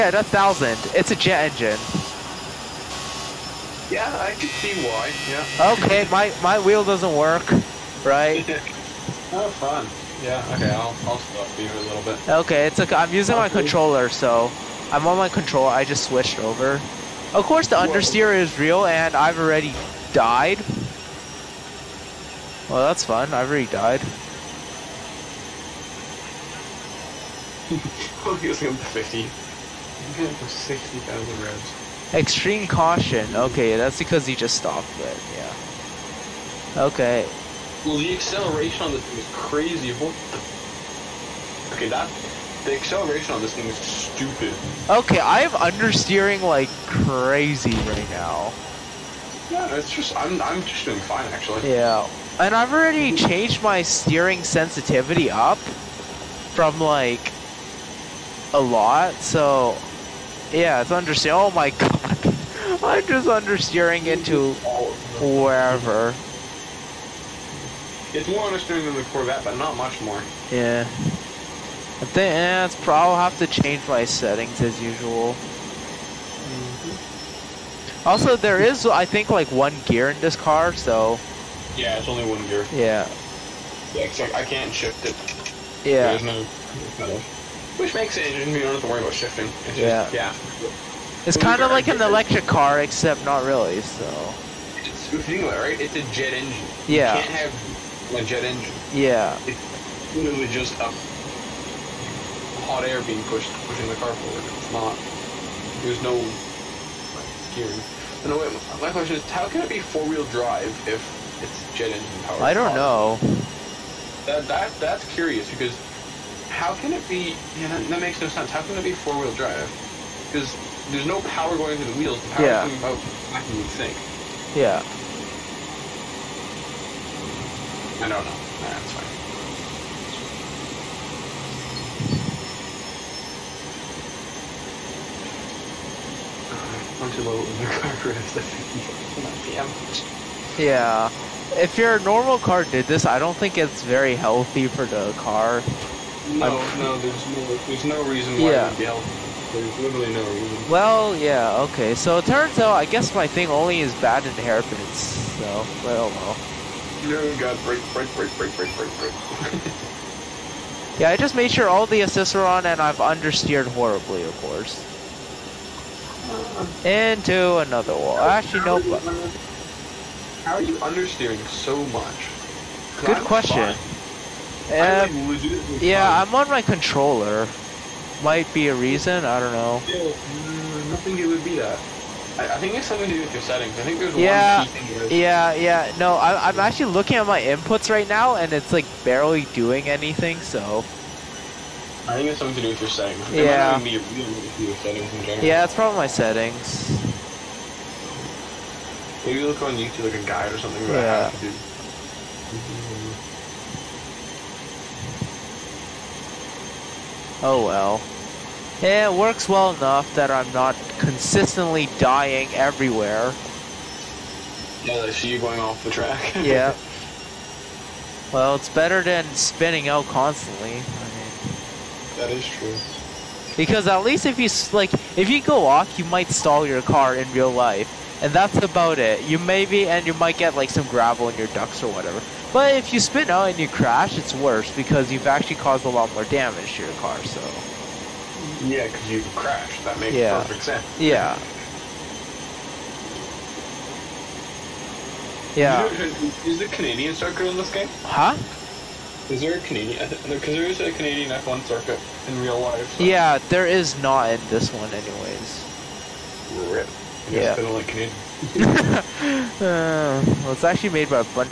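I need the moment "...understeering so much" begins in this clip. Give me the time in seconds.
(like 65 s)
170 s.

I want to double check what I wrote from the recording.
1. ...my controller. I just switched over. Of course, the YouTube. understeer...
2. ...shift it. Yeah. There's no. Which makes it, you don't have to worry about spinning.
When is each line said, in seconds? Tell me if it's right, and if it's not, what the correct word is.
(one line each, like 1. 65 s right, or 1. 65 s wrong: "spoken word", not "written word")
1. 15 s wrong: "Whoa", not "YouTube"
2. 84 s wrong: "shifting", not "spinning".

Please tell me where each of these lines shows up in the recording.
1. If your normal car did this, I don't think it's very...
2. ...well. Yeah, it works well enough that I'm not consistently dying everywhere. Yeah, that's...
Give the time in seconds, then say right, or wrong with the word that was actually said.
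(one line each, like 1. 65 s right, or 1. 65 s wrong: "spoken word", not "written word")
1. 141 s right
2. 207 s right.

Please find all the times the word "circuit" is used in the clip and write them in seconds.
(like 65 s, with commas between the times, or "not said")
247 s, 251 s.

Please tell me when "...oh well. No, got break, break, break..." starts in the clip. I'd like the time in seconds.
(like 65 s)
155 s.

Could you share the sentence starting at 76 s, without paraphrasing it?
Mm Also, there is, I think, like one gear in this car, so.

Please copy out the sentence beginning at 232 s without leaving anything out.
But if you spin out and you crash, it's worse because you've actually caused a lot more damage to your car, so.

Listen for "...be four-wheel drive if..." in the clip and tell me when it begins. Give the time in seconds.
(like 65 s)
109 s.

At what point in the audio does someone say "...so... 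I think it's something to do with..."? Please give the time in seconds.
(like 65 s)
190 s.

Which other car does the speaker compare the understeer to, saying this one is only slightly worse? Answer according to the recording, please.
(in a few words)
Corvette.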